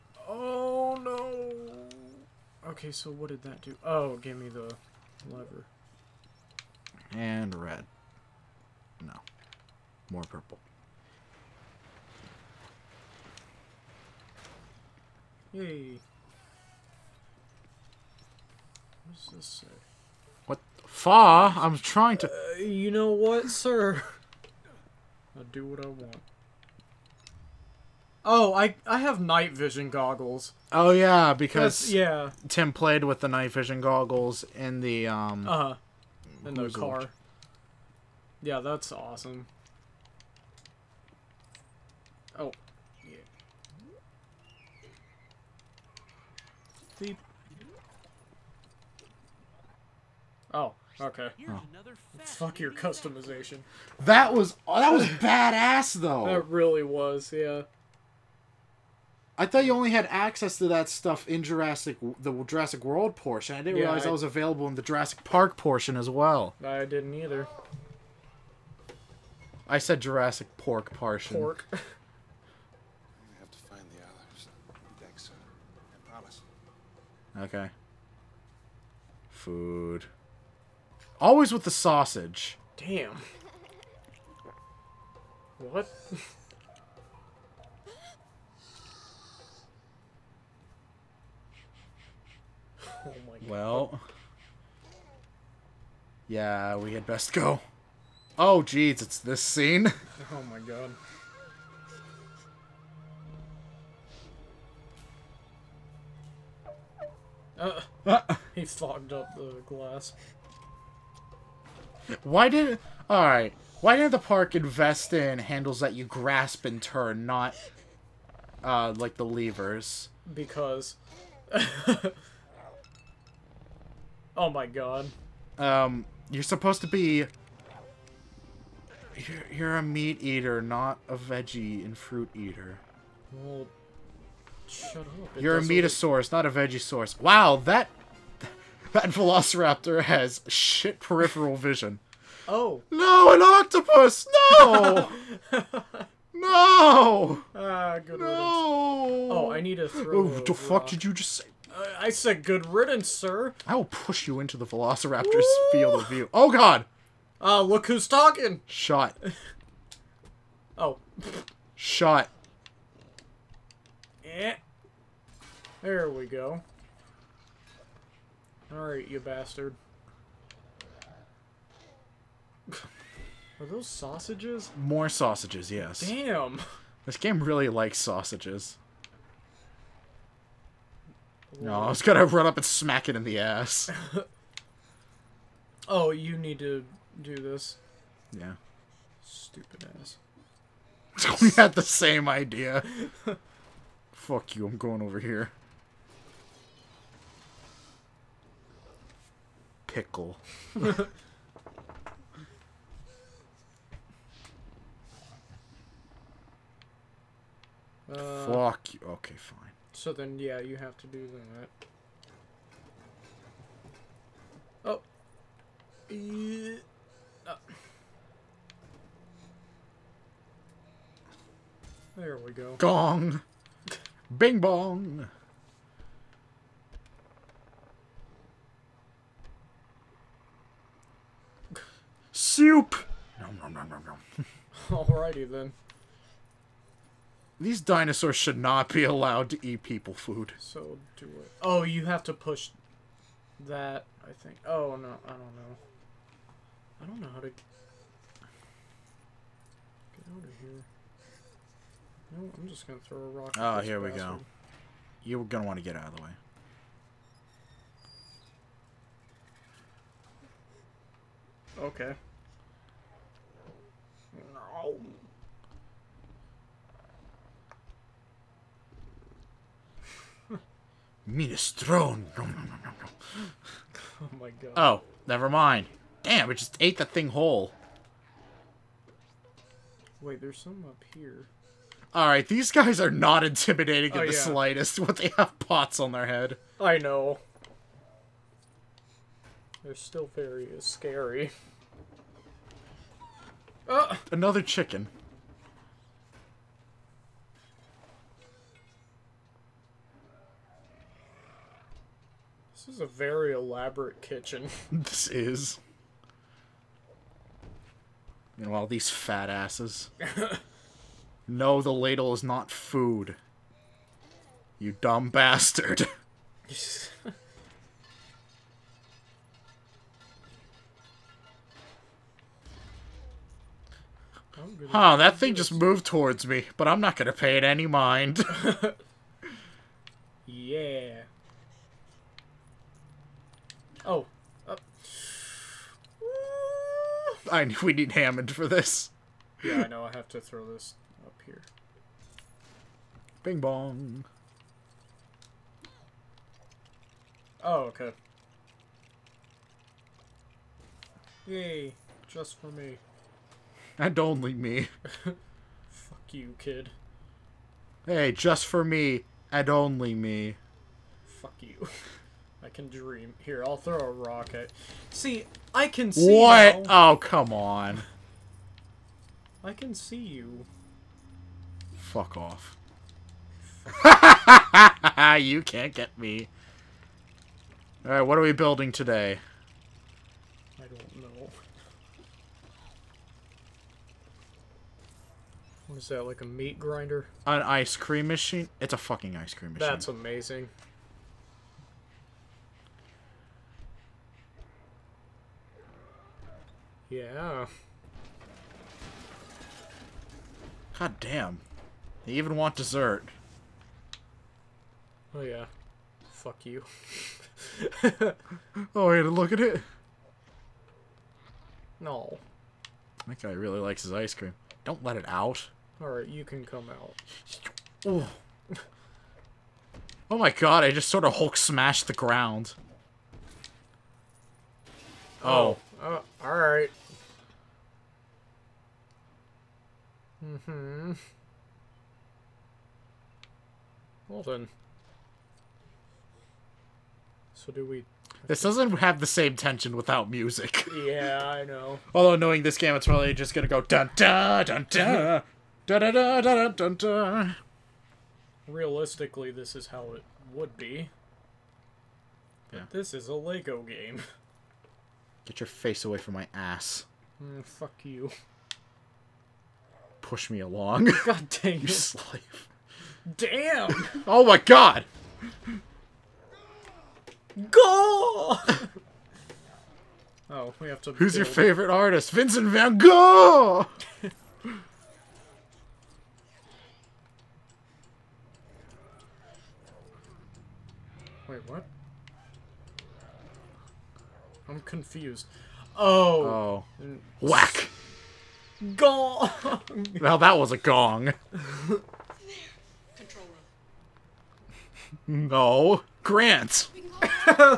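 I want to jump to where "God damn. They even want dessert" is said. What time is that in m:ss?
6:40.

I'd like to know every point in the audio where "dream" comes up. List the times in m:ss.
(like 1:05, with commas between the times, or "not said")
6:02.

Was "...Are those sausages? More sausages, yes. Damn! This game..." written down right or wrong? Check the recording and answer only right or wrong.
right.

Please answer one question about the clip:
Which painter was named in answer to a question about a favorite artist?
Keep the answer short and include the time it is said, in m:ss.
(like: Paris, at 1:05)
Vincent Van Gogh, at 7:52.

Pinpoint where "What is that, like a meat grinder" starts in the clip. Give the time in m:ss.
6:25.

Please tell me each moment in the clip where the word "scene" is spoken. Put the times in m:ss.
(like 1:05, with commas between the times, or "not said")
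1:39.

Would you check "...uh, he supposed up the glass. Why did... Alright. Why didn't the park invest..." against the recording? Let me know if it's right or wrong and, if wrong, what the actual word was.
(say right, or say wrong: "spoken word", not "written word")
wrong: "fogged", not "supposed".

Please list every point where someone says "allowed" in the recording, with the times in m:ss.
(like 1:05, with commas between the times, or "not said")
3:59.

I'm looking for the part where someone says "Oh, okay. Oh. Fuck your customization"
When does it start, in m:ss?
0:50.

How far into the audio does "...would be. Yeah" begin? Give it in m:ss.
7:30.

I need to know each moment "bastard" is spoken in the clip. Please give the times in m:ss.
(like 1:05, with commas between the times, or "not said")
2:49, 4:14, 5:15.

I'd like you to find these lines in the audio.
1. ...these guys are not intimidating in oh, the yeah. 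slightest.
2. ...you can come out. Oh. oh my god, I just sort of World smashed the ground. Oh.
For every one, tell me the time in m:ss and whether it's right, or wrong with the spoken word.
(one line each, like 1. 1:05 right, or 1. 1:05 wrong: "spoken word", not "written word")
1. 4:42 right
2. 6:56 wrong: "Hulk", not "World".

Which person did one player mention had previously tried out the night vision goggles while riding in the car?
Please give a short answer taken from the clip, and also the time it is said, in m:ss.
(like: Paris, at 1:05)
Tim, at 0:32.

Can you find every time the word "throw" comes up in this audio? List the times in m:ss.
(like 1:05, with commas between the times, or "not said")
2:29, 4:13, 5:40, 6:03.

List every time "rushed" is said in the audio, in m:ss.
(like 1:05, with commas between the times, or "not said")
not said.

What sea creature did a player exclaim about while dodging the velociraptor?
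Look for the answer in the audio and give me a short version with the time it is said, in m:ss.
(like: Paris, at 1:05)
An octopus, at 2:23.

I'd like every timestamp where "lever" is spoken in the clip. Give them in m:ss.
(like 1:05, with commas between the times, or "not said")
0:05, 1:59.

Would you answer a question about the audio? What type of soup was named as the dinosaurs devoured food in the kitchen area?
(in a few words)
Minestrone.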